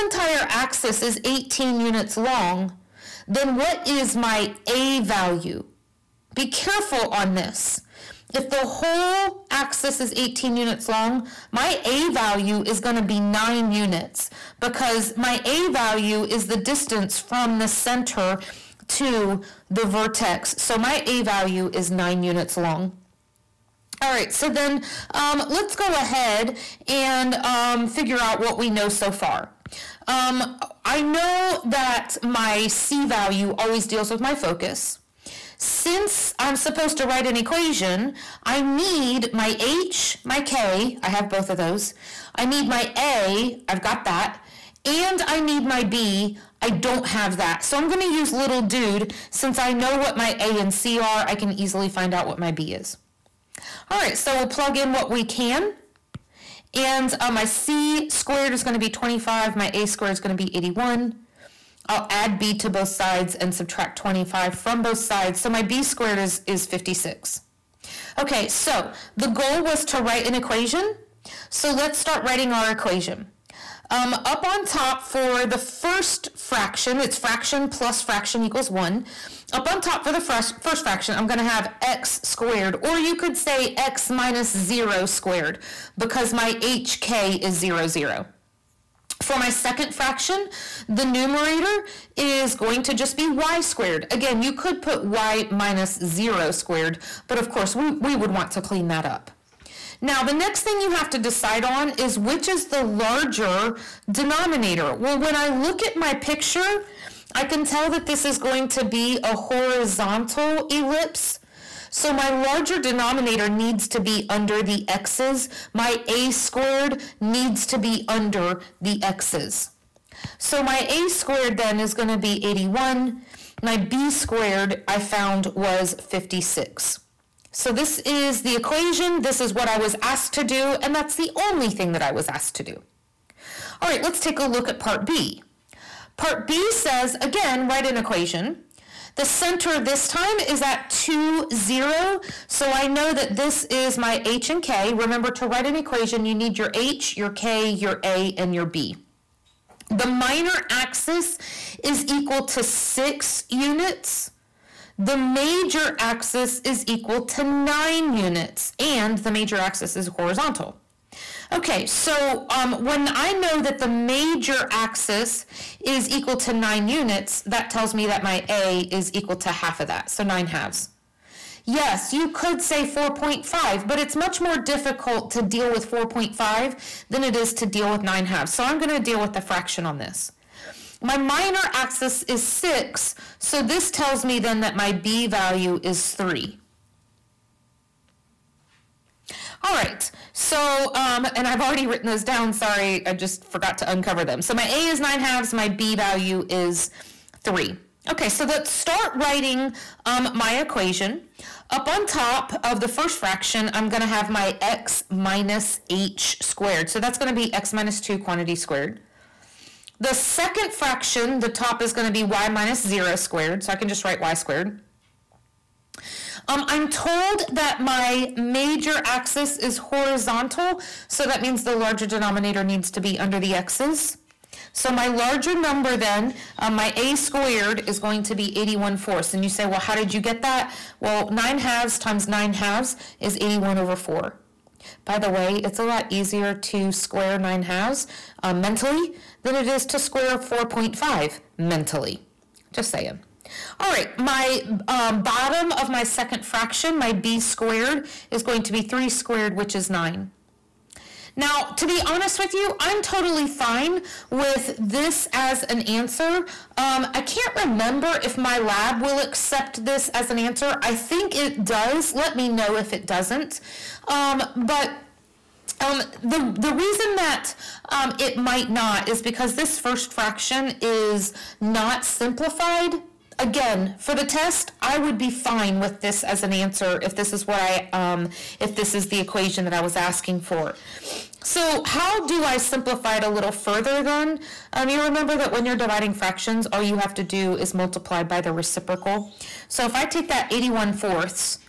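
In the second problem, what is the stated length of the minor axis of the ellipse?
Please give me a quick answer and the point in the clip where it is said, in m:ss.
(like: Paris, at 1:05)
6 units, at 2:32.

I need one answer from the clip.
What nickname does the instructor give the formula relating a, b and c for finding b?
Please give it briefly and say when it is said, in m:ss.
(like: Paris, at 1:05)
little dude, at 0:48.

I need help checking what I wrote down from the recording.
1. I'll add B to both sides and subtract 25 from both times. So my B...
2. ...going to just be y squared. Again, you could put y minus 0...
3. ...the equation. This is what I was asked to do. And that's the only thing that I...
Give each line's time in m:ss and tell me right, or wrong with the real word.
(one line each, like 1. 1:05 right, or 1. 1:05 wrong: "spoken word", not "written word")
1. 1:01 wrong: "sides", not "times"
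2. 1:32 right
3. 2:08 right.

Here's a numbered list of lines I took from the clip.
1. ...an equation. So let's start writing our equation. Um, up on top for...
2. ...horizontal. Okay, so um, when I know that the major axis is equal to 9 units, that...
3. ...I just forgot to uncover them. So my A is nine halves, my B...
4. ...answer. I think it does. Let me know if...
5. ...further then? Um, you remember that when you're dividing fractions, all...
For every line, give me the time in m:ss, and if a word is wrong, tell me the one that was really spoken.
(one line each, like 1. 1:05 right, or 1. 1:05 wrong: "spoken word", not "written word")
1. 1:10 right
2. 2:40 right
3. 3:13 right
4. 4:20 right
5. 4:43 right.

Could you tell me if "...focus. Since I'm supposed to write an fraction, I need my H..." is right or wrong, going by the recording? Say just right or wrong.
wrong.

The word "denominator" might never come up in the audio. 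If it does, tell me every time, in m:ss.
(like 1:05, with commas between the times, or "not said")
1:44, 1:52, 3:42.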